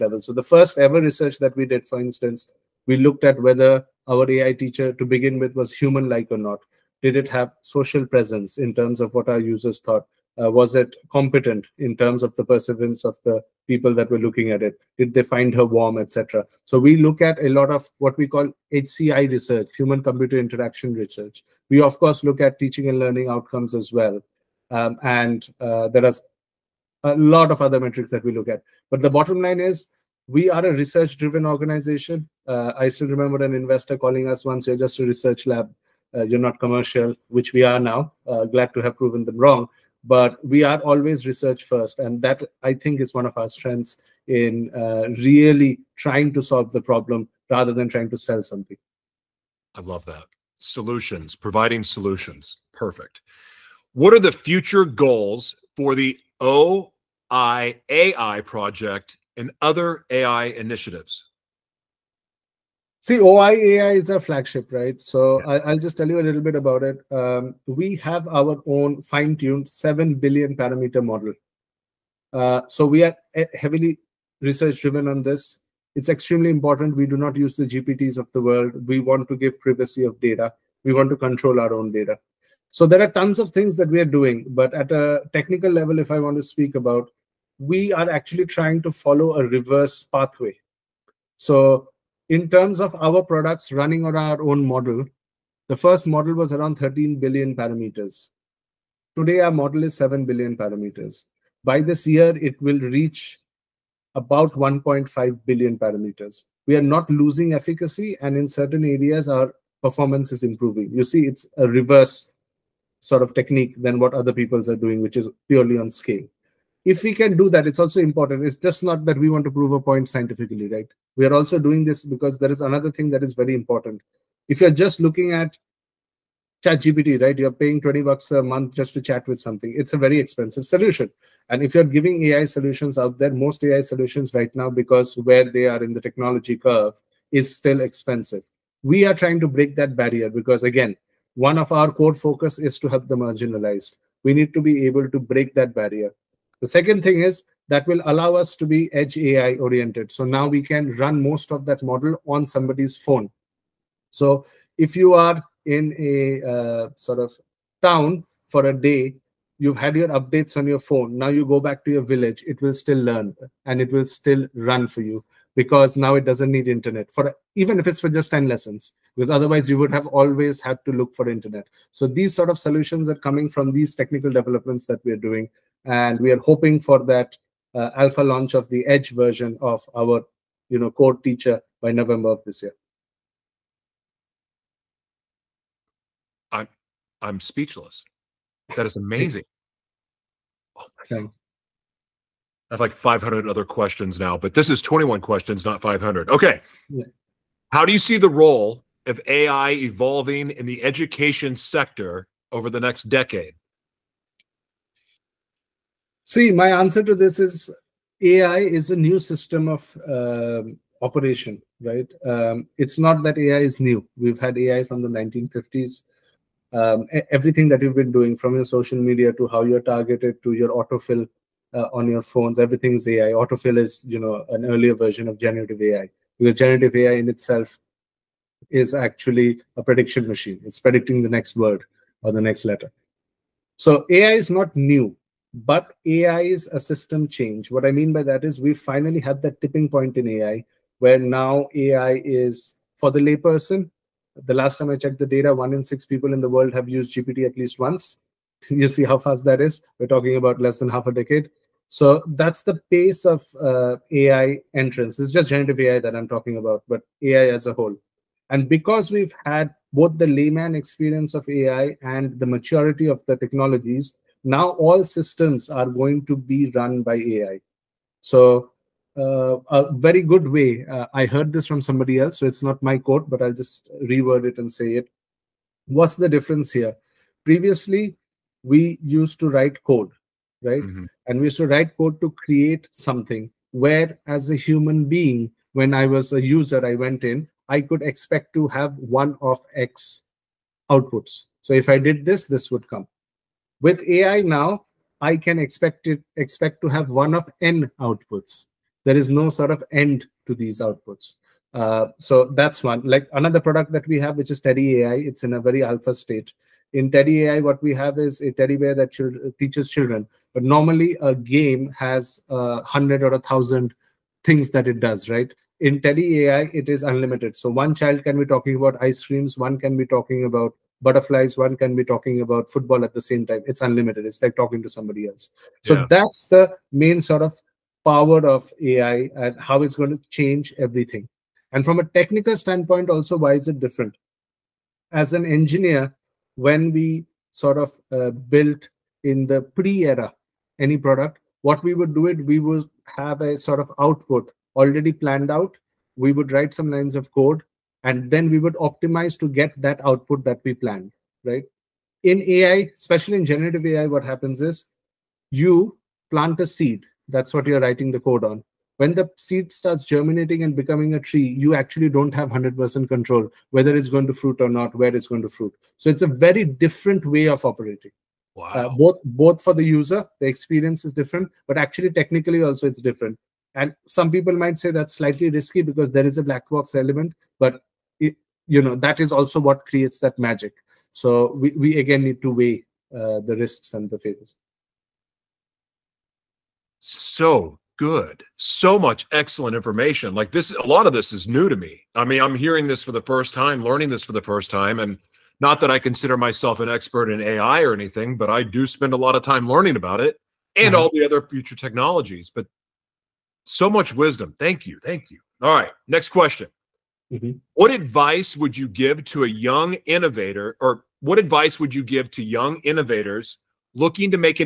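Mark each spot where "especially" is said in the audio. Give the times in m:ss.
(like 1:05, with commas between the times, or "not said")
5:52.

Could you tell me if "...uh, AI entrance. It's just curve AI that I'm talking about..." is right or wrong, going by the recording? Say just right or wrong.
wrong.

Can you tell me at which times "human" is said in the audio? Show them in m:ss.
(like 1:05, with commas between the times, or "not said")
0:05, 0:19, 4:44.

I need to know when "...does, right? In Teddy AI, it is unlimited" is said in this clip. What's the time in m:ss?
5:14.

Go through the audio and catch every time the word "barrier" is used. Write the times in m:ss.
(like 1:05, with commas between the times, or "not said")
2:20, 2:25.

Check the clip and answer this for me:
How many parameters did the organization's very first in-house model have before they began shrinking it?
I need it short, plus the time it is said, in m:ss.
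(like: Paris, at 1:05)
13 billion, at 1:36.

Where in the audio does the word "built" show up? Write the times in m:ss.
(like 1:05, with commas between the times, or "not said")
5:38.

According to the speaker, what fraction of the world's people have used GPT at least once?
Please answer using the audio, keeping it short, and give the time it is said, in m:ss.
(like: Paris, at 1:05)
one in six, at 4:05.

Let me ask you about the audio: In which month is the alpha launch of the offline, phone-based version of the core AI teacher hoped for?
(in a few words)
November.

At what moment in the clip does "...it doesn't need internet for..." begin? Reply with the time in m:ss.
2:46.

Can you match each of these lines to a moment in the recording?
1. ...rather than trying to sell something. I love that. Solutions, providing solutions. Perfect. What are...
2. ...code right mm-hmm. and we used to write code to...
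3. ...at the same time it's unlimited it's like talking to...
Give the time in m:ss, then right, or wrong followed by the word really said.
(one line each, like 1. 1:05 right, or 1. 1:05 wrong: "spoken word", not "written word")
1. 0:47 right
2. 4:39 right
3. 5:23 right.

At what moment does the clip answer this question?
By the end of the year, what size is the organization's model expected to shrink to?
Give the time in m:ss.
1:44.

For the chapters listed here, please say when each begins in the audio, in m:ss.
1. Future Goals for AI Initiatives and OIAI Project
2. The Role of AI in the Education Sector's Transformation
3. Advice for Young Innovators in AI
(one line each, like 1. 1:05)
1. 0:53
2. 3:15
3. 5:25.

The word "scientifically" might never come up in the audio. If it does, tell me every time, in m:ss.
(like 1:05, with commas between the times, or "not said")
2:00.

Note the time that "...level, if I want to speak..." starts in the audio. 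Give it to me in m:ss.
1:25.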